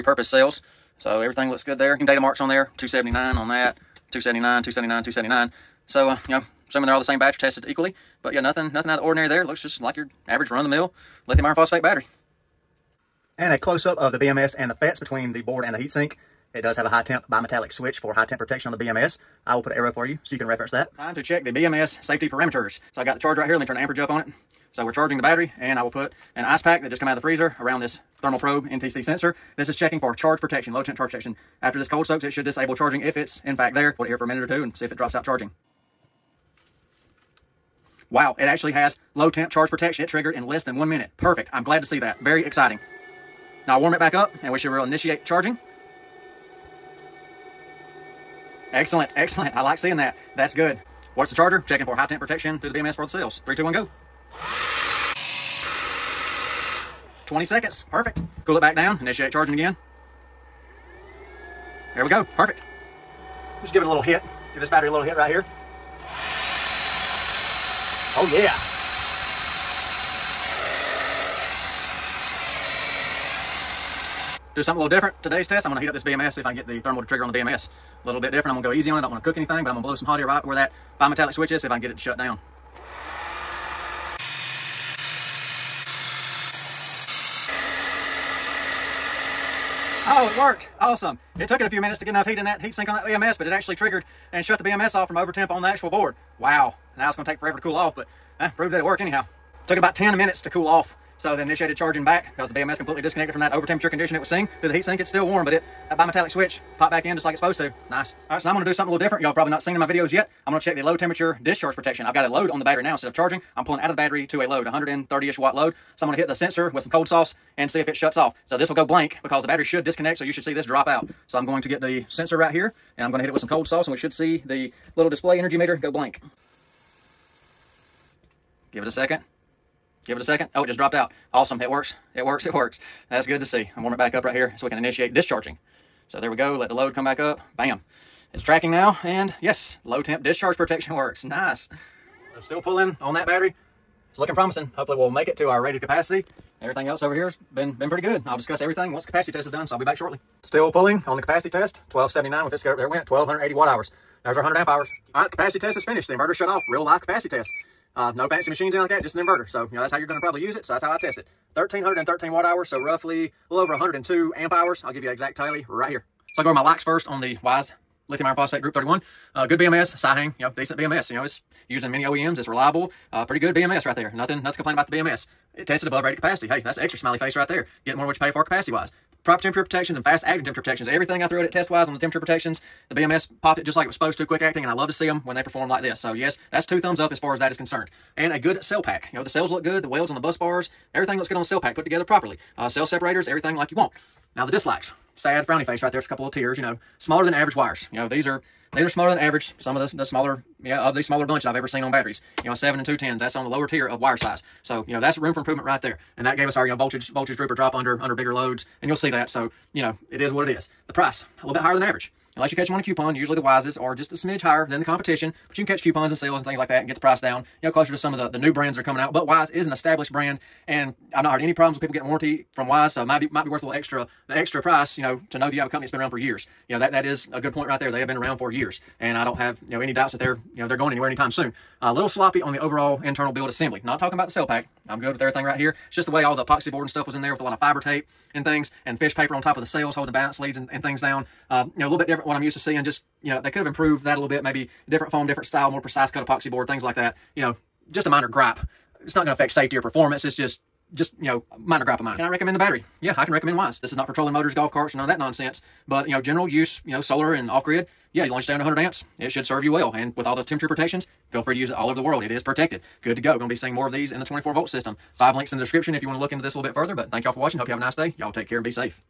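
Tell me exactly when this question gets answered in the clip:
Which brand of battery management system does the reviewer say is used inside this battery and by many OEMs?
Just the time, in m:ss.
2:49.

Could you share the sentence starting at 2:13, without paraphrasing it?
I'm warm it back up right here so we can initiate discharging.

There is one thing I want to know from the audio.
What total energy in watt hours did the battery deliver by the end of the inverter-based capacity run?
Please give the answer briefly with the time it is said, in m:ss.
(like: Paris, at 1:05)
1,313 watt hours, at 2:41.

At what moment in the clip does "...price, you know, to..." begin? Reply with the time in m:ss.
3:44.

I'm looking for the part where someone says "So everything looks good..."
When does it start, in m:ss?
0:00.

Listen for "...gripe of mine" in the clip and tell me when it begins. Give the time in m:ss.
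4:11.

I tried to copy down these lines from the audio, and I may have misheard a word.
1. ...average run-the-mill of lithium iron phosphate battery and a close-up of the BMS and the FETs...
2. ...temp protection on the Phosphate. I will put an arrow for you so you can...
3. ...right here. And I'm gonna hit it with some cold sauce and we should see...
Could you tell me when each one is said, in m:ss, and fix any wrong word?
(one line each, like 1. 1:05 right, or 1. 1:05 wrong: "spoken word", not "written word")
1. 0:10 right
2. 0:18 wrong: "BMS", not "Phosphate"
3. 2:02 right.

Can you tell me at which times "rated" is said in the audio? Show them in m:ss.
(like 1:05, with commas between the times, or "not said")
2:25, 2:56.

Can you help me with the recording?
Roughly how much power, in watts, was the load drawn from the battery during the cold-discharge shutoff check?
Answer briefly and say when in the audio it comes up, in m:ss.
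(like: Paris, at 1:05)
130 watts, at 1:54.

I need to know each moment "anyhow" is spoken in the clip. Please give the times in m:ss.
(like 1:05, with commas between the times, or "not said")
1:38.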